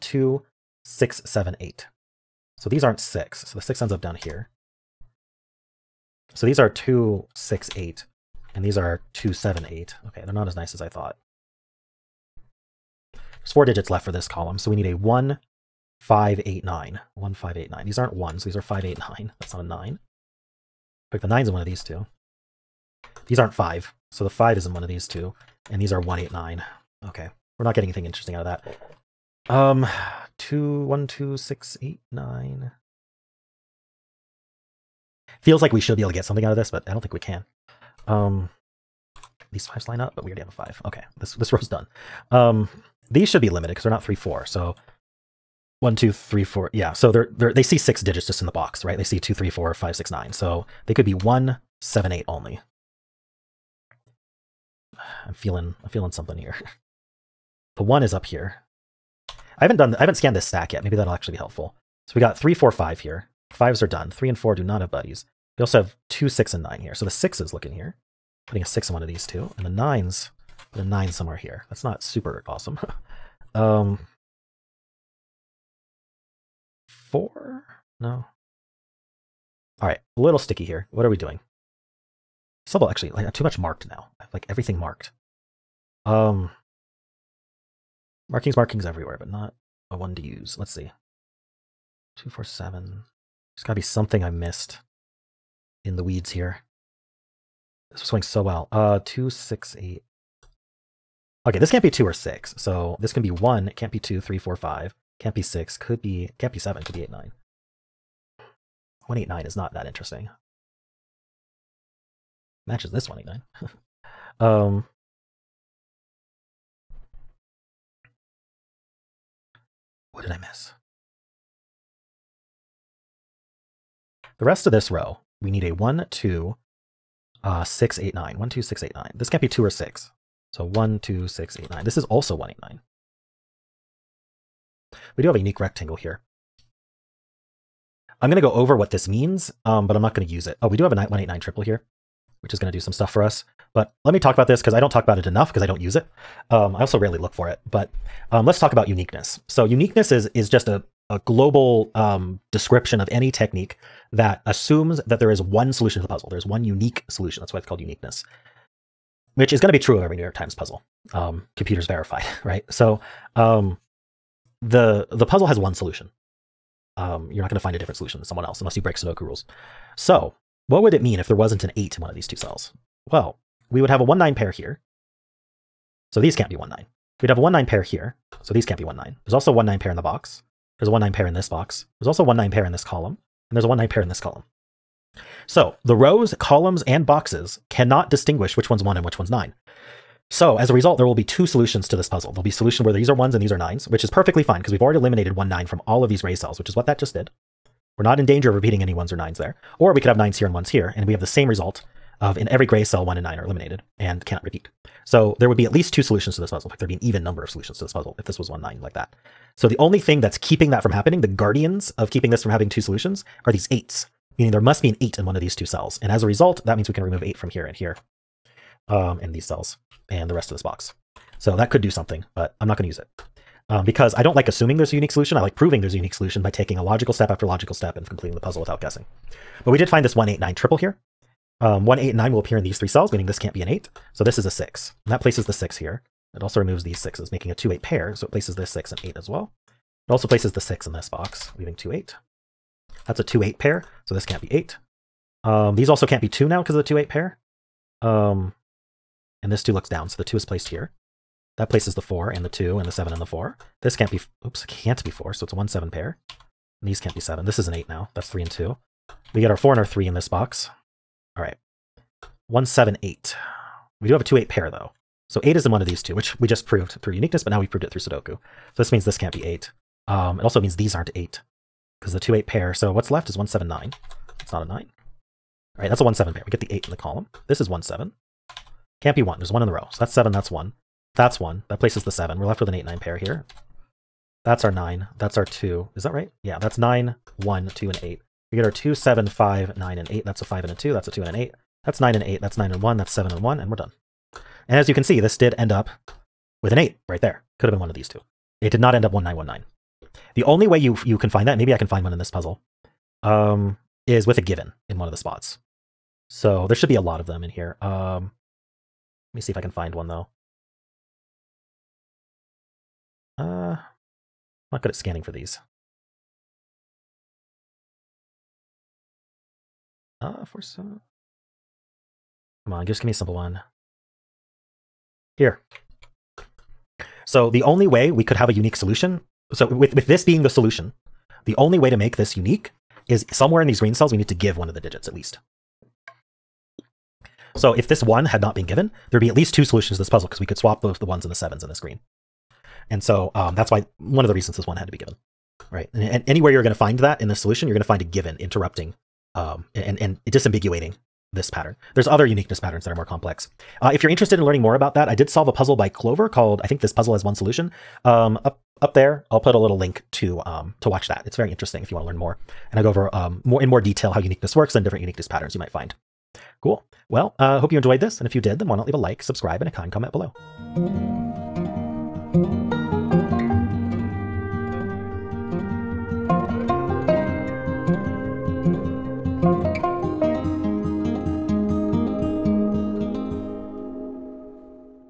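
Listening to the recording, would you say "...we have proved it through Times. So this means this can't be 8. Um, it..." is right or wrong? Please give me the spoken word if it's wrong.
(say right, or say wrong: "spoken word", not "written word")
wrong: "Sudoku", not "Times".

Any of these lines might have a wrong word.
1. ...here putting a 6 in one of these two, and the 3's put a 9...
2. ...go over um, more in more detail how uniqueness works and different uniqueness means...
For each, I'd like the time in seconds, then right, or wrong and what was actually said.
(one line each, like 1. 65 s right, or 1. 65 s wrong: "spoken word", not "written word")
1. 67 s wrong: "9", not "3"
2. 362 s wrong: "patterns", not "means".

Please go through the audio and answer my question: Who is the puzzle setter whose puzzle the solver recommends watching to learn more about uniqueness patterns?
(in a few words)
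Clover.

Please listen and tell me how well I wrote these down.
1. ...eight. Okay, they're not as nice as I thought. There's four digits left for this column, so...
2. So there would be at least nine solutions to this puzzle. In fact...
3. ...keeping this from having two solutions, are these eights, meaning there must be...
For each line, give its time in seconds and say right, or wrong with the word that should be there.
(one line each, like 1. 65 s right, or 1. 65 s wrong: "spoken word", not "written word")
1. 9 s right
2. 205 s wrong: "two", not "nine"
3. 212 s right.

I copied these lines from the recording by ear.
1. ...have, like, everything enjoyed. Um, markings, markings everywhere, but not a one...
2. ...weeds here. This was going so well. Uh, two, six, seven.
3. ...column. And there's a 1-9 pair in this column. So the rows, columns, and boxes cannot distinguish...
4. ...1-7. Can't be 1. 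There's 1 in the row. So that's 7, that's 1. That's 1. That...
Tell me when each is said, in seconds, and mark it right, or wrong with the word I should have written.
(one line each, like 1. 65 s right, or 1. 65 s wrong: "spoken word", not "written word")
1. 84 s wrong: "marked", not "enjoyed"
2. 96 s wrong: "eight", not "seven"
3. 182 s right
4. 277 s right.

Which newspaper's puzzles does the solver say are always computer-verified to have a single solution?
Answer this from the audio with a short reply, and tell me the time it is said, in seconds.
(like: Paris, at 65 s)
New York Times, at 160 s.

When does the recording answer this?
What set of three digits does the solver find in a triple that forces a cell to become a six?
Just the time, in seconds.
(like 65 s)
230 s.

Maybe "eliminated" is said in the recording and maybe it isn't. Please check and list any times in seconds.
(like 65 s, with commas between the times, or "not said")
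194 s, 203 s.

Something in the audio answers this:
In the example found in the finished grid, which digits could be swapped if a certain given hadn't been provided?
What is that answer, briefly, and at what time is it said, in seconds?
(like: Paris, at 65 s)
1 and 7, at 340 s.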